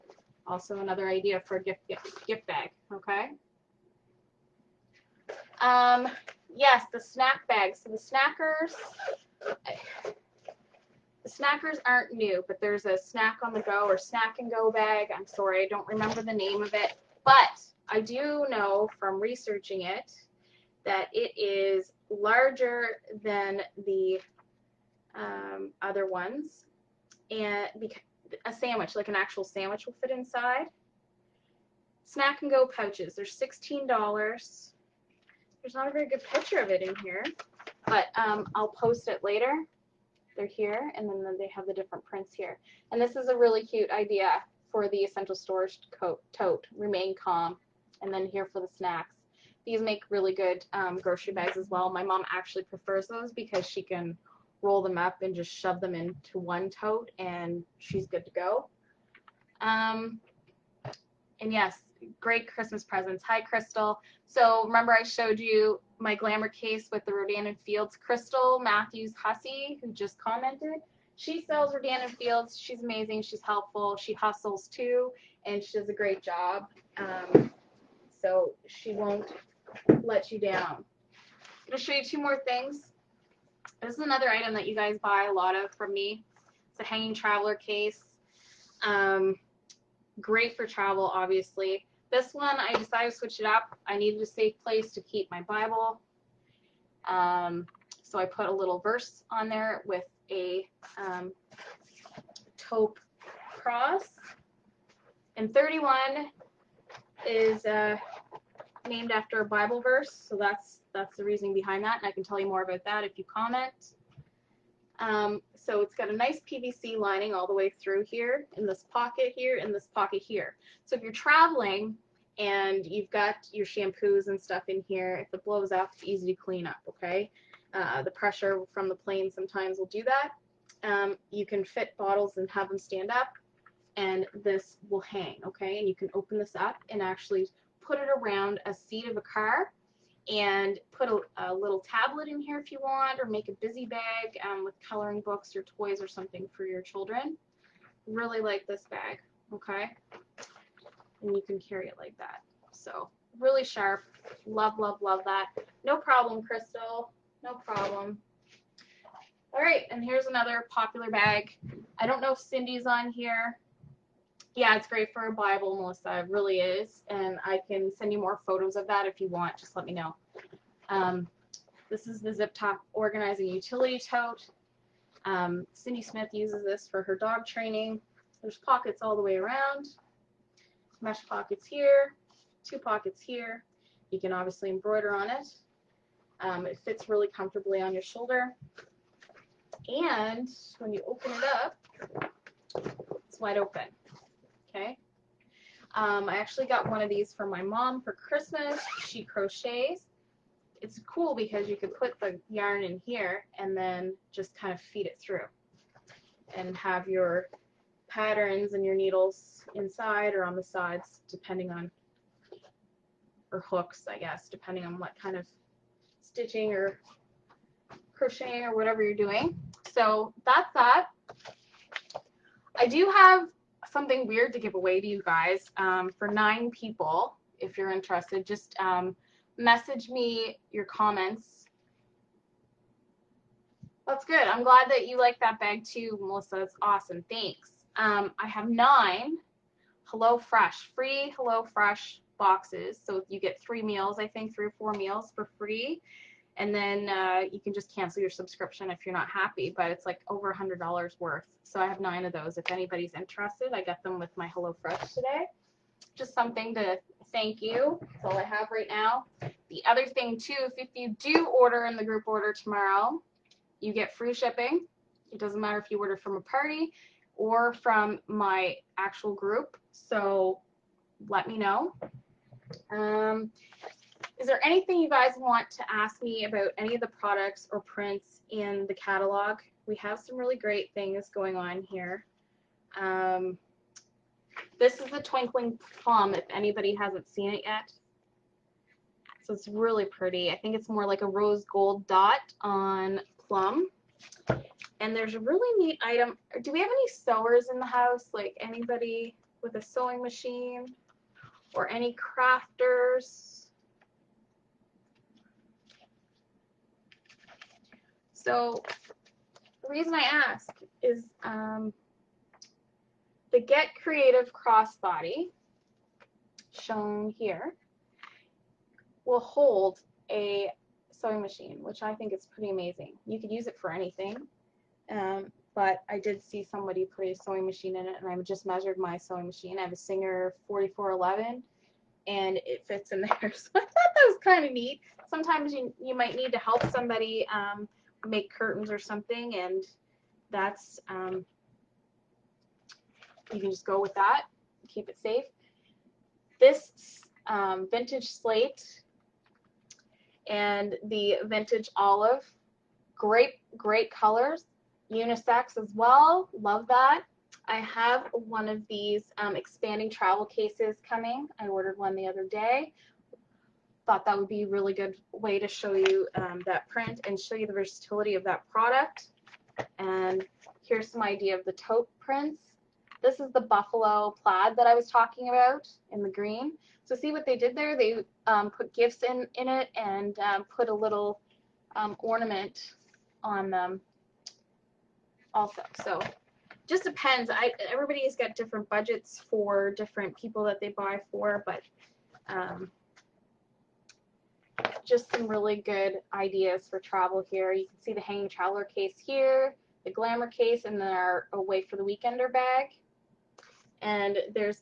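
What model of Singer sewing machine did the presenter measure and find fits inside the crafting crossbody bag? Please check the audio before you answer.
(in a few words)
4411.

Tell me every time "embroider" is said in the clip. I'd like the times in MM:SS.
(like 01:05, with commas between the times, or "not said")
03:04.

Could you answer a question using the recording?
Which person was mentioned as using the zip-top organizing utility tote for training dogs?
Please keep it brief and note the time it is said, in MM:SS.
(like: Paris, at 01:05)
Cindy Smith, at 02:55.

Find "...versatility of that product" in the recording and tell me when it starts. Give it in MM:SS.
06:07.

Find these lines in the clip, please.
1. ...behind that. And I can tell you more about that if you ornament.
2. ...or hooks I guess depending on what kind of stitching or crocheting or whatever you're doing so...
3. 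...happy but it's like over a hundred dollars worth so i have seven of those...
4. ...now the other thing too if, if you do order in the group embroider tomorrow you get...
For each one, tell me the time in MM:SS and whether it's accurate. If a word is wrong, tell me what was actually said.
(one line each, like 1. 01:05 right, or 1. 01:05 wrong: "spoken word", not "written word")
1. 01:51 wrong: "comment", not "ornament"
2. 03:33 right
3. 04:09 wrong: "nine", not "seven"
4. 04:18 wrong: "order", not "embroider".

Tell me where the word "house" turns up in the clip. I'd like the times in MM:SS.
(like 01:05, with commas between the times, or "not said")
04:57.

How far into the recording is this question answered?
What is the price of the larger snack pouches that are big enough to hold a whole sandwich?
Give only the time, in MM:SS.
00:33.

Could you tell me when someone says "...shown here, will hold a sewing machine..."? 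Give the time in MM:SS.
05:16.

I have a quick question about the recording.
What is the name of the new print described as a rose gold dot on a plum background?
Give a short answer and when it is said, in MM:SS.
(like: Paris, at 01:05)
Twinkling Plum, at 04:45.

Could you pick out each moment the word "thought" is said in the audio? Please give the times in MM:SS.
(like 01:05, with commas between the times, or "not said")
05:33, 06:04.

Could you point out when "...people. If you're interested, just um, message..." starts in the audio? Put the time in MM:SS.
03:46.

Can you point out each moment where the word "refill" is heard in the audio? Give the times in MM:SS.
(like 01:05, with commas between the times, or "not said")
not said.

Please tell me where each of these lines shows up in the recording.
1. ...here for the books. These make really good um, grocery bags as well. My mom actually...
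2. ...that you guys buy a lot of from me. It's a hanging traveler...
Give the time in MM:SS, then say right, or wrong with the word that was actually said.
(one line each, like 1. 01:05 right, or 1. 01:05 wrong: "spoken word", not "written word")
1. 00:48 wrong: "snacks", not "books"
2. 01:24 right.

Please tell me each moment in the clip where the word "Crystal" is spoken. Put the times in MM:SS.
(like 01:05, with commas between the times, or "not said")
01:03, 01:07, 02:36.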